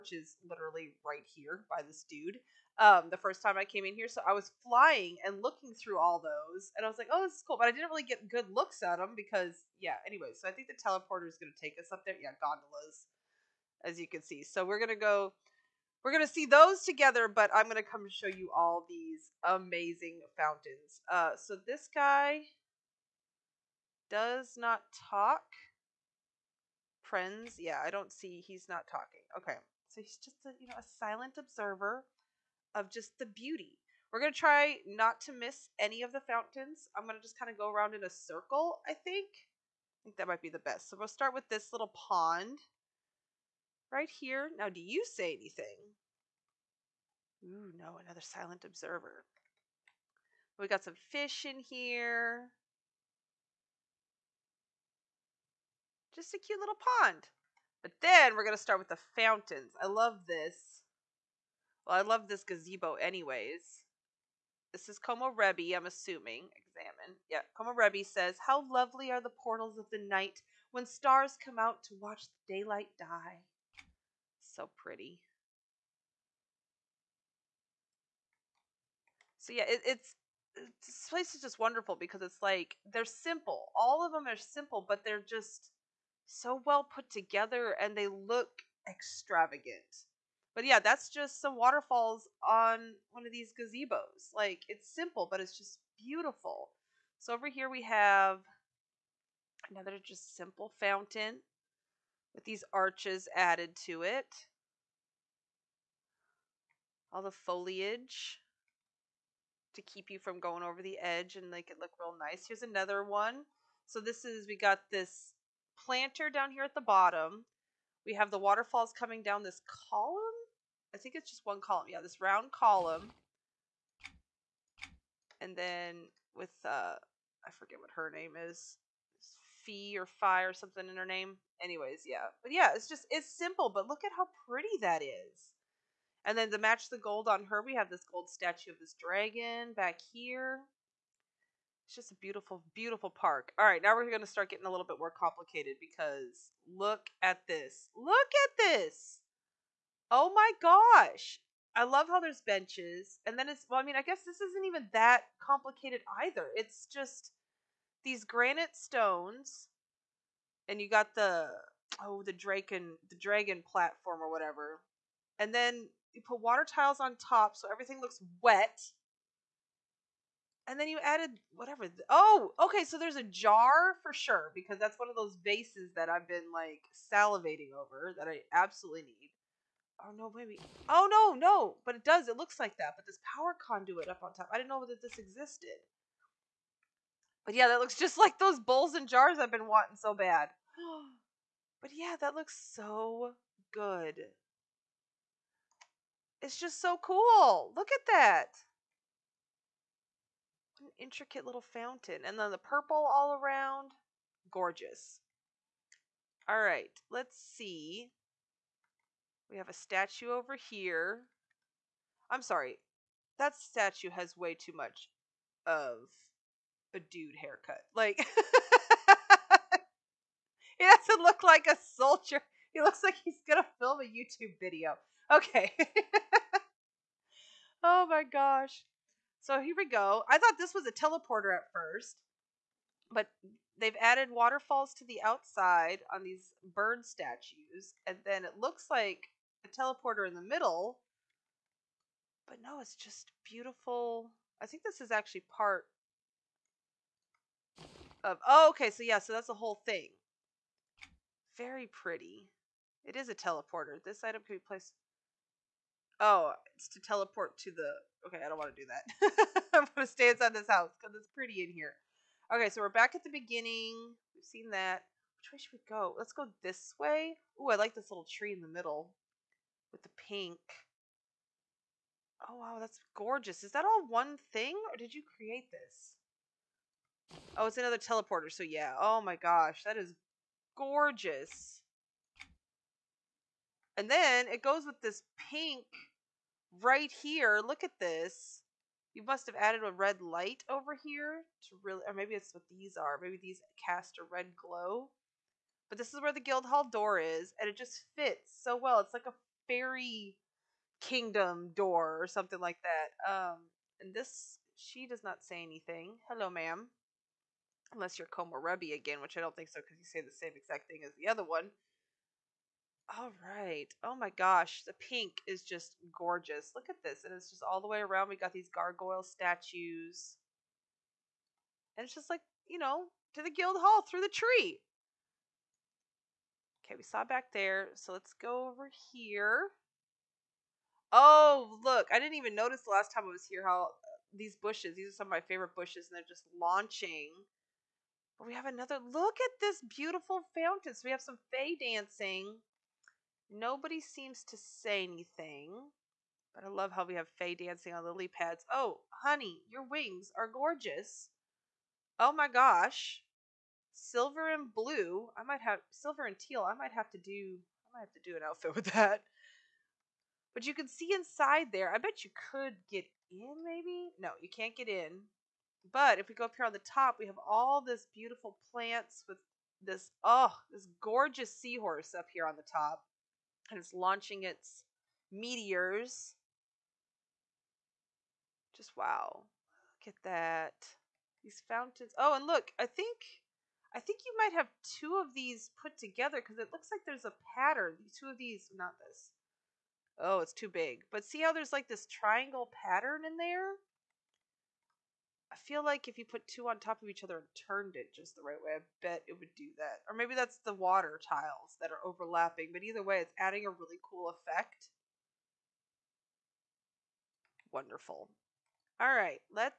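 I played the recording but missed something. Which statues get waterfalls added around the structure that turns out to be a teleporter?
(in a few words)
Bird statues.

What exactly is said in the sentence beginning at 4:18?
Okay, I don't want to do that.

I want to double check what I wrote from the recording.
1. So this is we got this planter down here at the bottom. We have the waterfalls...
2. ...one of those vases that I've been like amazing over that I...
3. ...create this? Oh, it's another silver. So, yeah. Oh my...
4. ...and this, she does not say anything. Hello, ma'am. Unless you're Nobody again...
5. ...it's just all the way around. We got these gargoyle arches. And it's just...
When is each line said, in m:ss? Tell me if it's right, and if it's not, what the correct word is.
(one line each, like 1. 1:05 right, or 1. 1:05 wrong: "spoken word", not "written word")
1. 1:53 right
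2. 2:54 wrong: "salivating", not "amazing"
3. 4:35 wrong: "teleporter", not "silver"
4. 5:04 wrong: "Komorebi", not "Nobody"
5. 5:17 wrong: "statues", not "arches".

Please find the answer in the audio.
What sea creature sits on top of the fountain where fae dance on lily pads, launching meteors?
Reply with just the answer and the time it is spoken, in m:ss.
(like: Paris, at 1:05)
Seahorse, at 6:11.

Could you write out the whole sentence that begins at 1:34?
Like it's simple, but it's just beautiful.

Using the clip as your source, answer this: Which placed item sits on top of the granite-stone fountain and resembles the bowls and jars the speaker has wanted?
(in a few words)
Power conduit.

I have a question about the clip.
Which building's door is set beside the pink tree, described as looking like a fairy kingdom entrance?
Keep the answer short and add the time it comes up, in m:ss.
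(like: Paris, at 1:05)
Guildhall, at 4:56.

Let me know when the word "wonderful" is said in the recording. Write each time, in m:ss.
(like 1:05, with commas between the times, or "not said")
1:21, 6:47.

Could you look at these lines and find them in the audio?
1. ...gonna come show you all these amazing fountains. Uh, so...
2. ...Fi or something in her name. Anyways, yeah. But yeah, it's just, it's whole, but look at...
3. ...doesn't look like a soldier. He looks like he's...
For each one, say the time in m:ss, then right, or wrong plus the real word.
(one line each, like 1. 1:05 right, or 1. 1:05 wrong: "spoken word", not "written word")
1. 0:17 right
2. 2:10 wrong: "simple", not "whole"
3. 3:40 right.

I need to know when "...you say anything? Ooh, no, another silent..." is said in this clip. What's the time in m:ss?
0:44.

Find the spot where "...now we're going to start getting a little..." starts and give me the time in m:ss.
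2:23.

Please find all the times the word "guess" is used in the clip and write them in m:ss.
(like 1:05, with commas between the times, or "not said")
2:34.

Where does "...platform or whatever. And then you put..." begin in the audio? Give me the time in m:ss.
2:43.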